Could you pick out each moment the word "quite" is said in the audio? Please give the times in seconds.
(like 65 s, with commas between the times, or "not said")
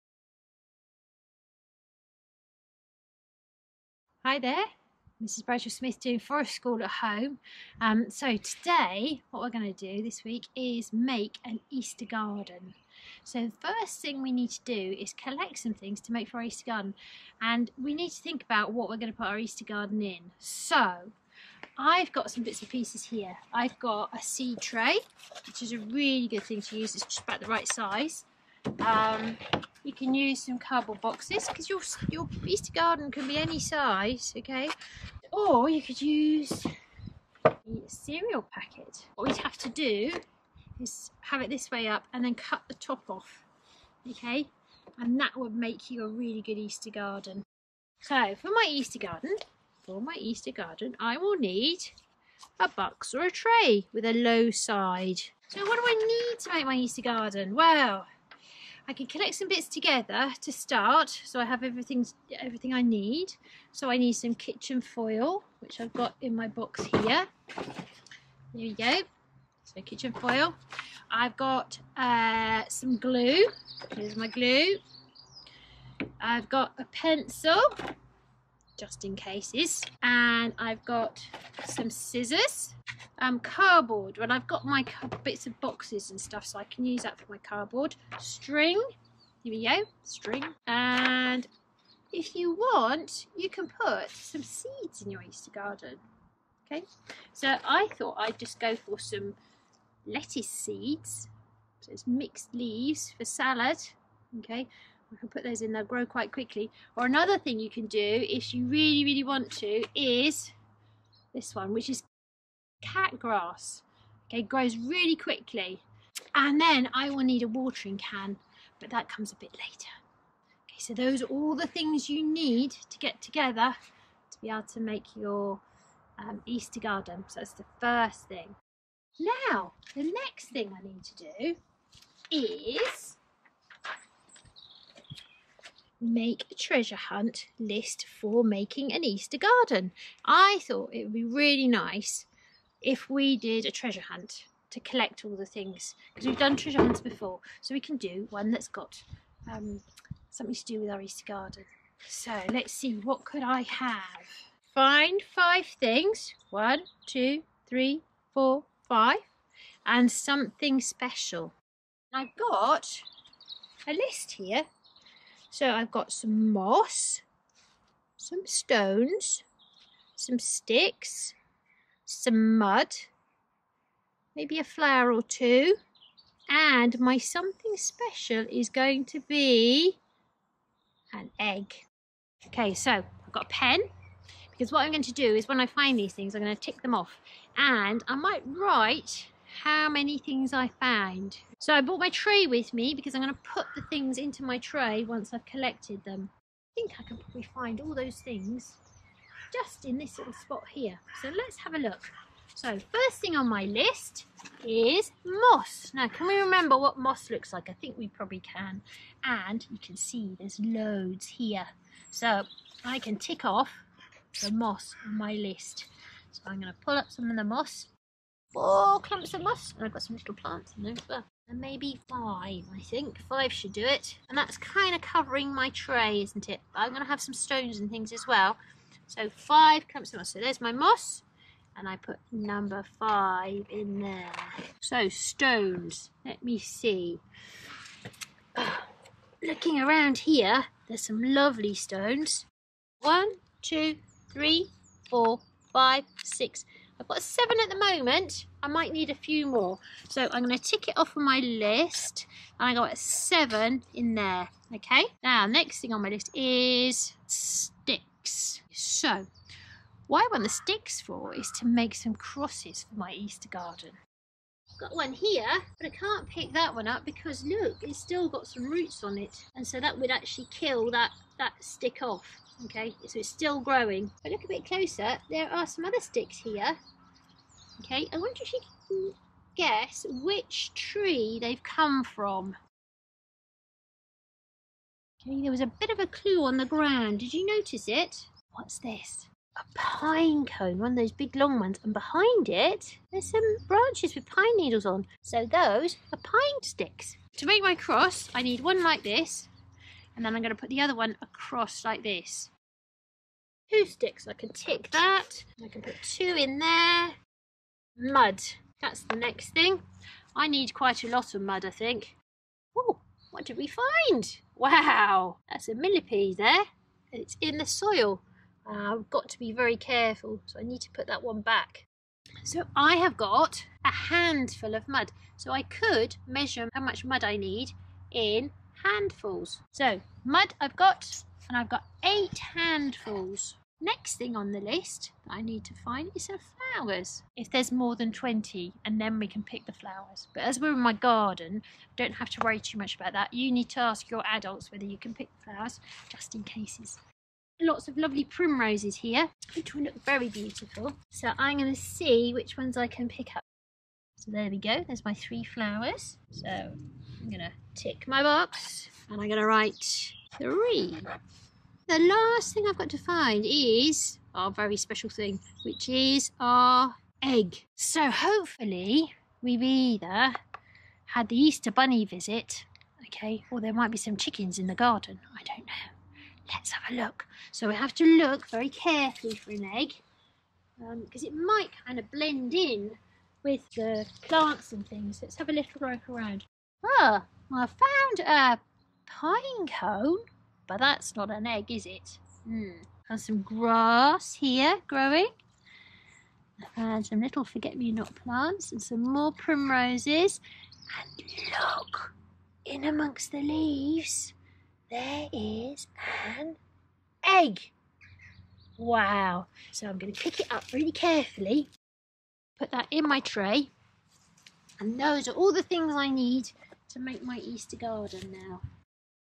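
106 s, 310 s.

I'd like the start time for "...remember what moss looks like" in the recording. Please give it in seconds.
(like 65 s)
206 s.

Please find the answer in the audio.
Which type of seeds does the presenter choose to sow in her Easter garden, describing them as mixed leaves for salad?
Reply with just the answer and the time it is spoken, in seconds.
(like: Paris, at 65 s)
Lettuce seeds, at 100 s.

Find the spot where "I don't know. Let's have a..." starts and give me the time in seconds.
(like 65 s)
375 s.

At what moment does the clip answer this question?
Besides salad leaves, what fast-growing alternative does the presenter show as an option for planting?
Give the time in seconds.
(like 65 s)
112 s.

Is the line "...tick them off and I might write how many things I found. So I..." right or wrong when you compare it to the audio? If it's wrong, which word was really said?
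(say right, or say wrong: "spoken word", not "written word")
right.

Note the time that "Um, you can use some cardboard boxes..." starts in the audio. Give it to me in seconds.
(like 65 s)
28 s.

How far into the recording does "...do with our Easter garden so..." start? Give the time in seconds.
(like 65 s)
150 s.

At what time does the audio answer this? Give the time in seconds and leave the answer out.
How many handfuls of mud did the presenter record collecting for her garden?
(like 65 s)
332 s.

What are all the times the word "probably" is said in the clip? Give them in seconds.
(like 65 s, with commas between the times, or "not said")
197 s, 208 s.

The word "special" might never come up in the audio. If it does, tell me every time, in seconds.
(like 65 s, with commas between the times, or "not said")
160 s, 177 s, 364 s.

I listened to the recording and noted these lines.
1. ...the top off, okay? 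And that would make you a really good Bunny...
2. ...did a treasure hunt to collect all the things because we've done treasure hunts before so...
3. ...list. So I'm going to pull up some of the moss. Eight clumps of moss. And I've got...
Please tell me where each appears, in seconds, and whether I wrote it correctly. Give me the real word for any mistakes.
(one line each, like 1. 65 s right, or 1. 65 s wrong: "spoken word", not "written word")
1. 42 s wrong: "Easter", not "Bunny"
2. 143 s right
3. 215 s wrong: "Four", not "Eight".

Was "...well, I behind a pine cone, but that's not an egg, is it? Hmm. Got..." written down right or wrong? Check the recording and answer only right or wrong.
wrong.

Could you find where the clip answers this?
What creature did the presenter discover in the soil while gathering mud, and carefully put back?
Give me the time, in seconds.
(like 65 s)
315 s.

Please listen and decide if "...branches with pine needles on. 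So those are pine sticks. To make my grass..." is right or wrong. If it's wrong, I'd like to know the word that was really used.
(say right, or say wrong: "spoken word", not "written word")
wrong: "cross", not "grass".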